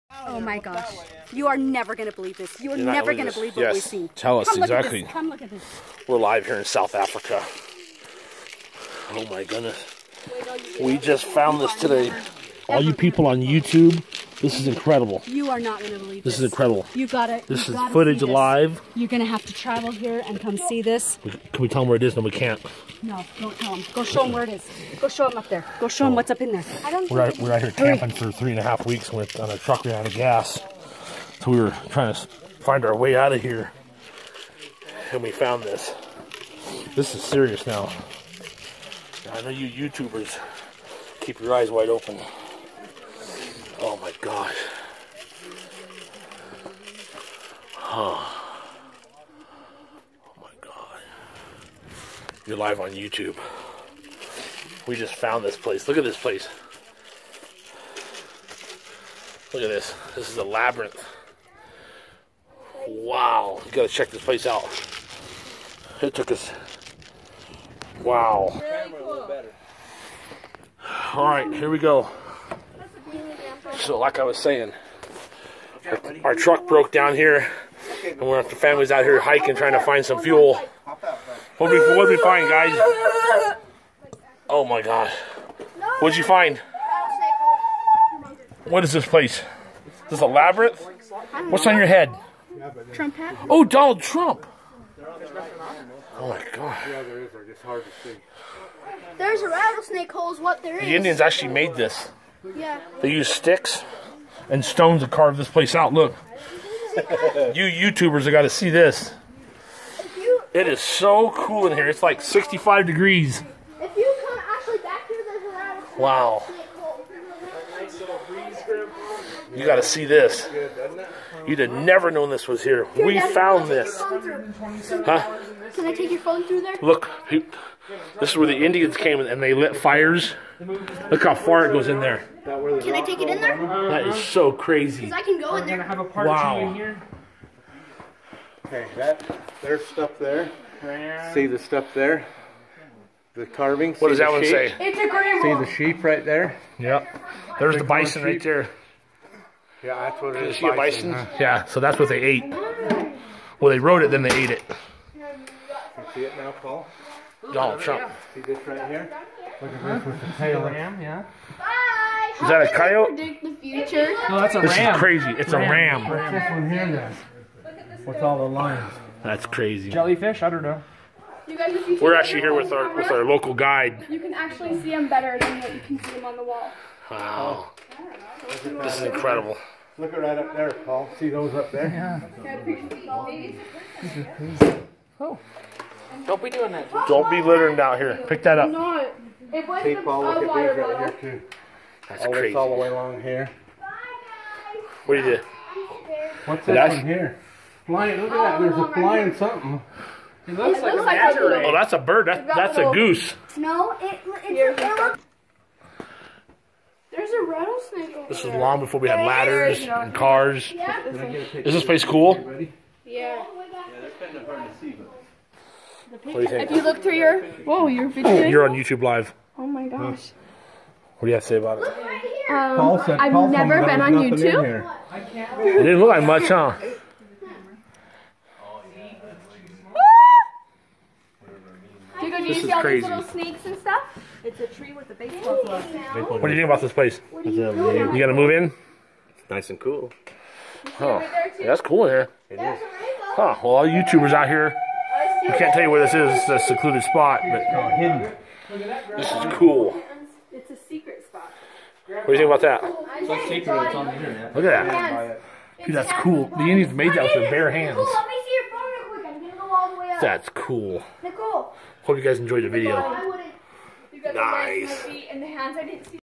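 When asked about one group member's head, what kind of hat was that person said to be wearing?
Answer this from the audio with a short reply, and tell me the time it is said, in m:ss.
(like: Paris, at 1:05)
Trump hat, at 1:32.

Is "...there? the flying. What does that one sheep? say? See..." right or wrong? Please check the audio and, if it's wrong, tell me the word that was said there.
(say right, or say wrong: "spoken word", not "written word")
wrong: "carving", not "flying".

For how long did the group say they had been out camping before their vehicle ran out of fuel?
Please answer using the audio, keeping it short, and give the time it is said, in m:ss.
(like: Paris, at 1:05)
3.5 weeks, at 0:28.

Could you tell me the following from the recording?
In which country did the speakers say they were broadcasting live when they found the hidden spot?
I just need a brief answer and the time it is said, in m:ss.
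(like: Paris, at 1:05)
South Africa, at 0:06.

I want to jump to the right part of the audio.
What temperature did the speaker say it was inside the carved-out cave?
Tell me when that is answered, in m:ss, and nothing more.
1:52.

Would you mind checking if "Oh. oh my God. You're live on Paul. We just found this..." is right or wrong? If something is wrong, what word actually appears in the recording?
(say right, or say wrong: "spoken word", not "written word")
wrong: "YouTube", not "Paul".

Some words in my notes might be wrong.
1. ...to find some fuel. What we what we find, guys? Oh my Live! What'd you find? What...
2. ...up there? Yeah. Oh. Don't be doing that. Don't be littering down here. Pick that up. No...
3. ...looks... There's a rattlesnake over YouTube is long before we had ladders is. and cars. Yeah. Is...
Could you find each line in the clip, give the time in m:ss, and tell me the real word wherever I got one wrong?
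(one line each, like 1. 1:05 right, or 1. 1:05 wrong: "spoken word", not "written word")
1. 1:19 wrong: "God", not "Live"
2. 3:01 right
3. 3:24 wrong: "This", not "YouTube".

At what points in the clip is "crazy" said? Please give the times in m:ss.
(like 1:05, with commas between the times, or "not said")
2:14, 2:44, 2:49, 3:12, 3:52.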